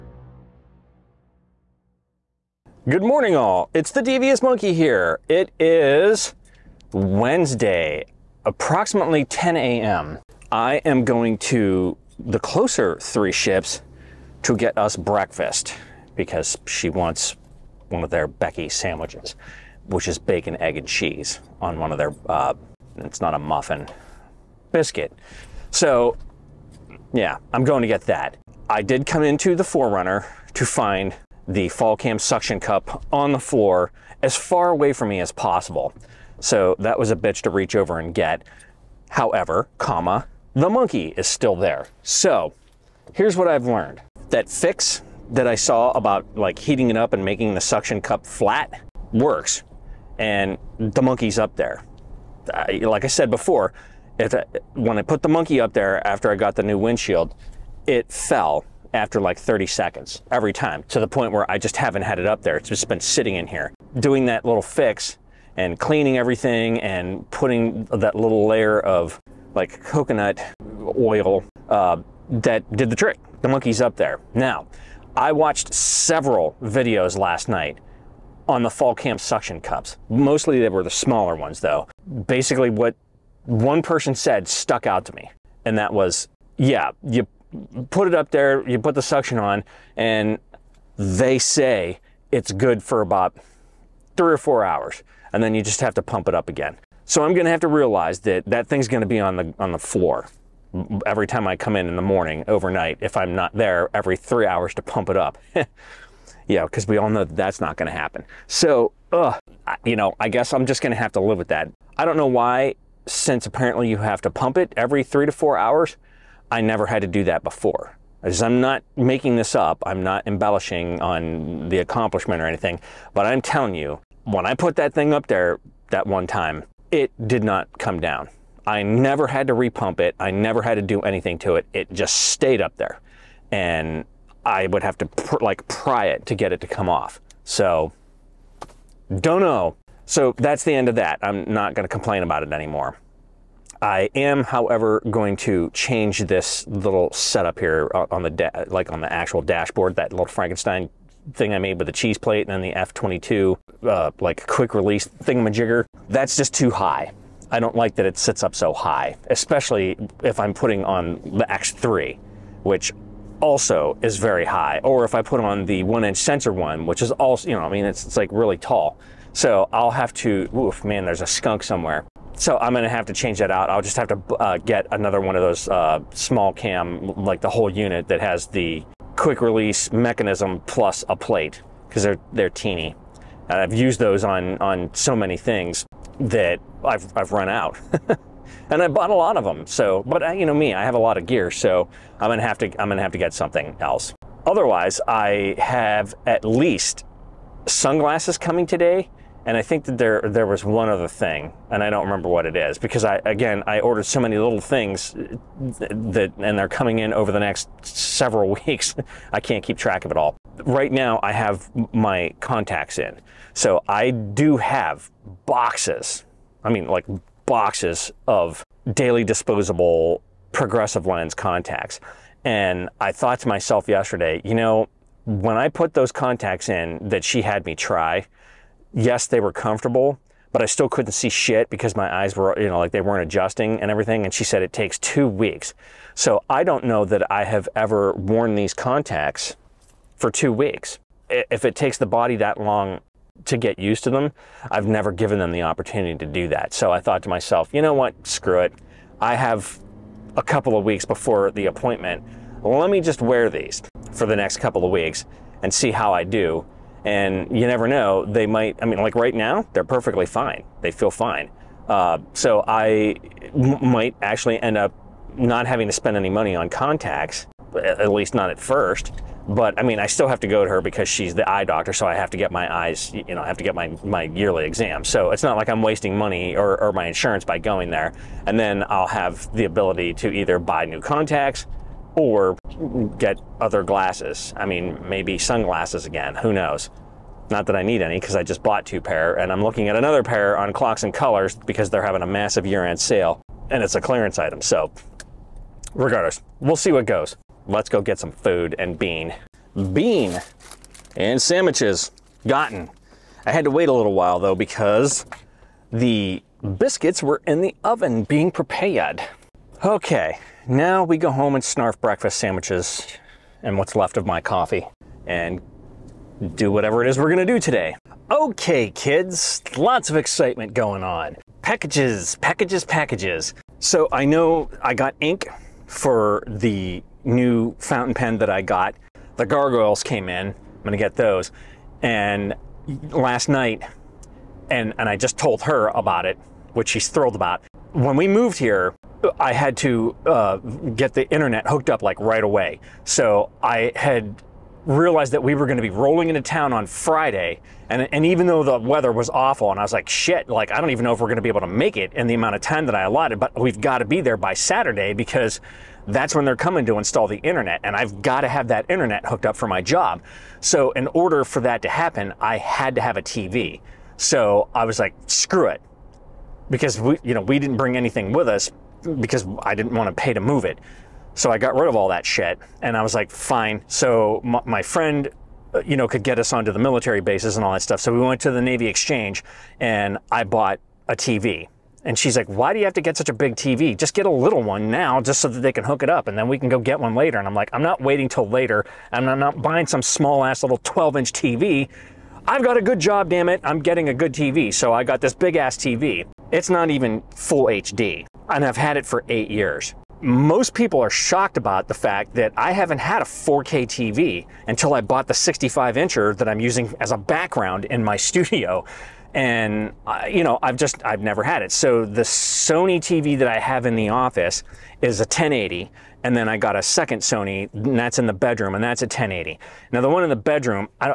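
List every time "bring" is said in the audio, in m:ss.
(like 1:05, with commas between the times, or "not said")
6:07.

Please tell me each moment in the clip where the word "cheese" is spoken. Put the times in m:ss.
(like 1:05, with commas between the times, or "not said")
0:20, 2:31.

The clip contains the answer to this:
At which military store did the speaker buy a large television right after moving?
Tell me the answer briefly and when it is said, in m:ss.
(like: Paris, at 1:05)
Navy Exchange, at 6:18.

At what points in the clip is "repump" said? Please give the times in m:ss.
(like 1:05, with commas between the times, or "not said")
2:09.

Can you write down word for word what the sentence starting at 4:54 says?
So regardless, we'll see what goes.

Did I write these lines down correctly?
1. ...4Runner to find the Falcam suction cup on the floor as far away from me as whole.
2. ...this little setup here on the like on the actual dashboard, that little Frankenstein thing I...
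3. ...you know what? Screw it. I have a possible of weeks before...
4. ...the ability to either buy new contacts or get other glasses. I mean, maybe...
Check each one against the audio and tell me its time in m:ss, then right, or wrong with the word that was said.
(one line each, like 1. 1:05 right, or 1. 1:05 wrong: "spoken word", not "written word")
1. 0:29 wrong: "possible", not "whole"
2. 2:26 right
3. 4:07 wrong: "couple", not "possible"
4. 4:39 right.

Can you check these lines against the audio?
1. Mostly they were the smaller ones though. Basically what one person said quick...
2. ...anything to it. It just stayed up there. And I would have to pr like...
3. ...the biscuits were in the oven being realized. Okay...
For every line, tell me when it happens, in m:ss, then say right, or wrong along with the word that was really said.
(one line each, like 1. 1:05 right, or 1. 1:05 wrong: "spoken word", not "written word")
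1. 1:20 wrong: "stuck", not "quick"
2. 2:11 right
3. 5:05 wrong: "prepared", not "realized".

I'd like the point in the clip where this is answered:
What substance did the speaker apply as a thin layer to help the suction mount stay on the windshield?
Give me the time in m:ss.
1:09.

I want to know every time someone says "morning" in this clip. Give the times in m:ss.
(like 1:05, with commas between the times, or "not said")
0:03, 1:42.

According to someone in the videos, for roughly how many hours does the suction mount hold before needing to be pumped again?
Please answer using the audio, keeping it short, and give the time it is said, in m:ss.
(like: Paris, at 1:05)
3 or 4 hours, at 1:34.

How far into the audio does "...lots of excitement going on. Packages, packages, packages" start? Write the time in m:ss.
5:19.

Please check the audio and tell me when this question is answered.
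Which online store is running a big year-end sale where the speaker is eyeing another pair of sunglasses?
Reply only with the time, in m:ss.
4:50.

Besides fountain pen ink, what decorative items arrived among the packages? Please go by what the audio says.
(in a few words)
gargoyles.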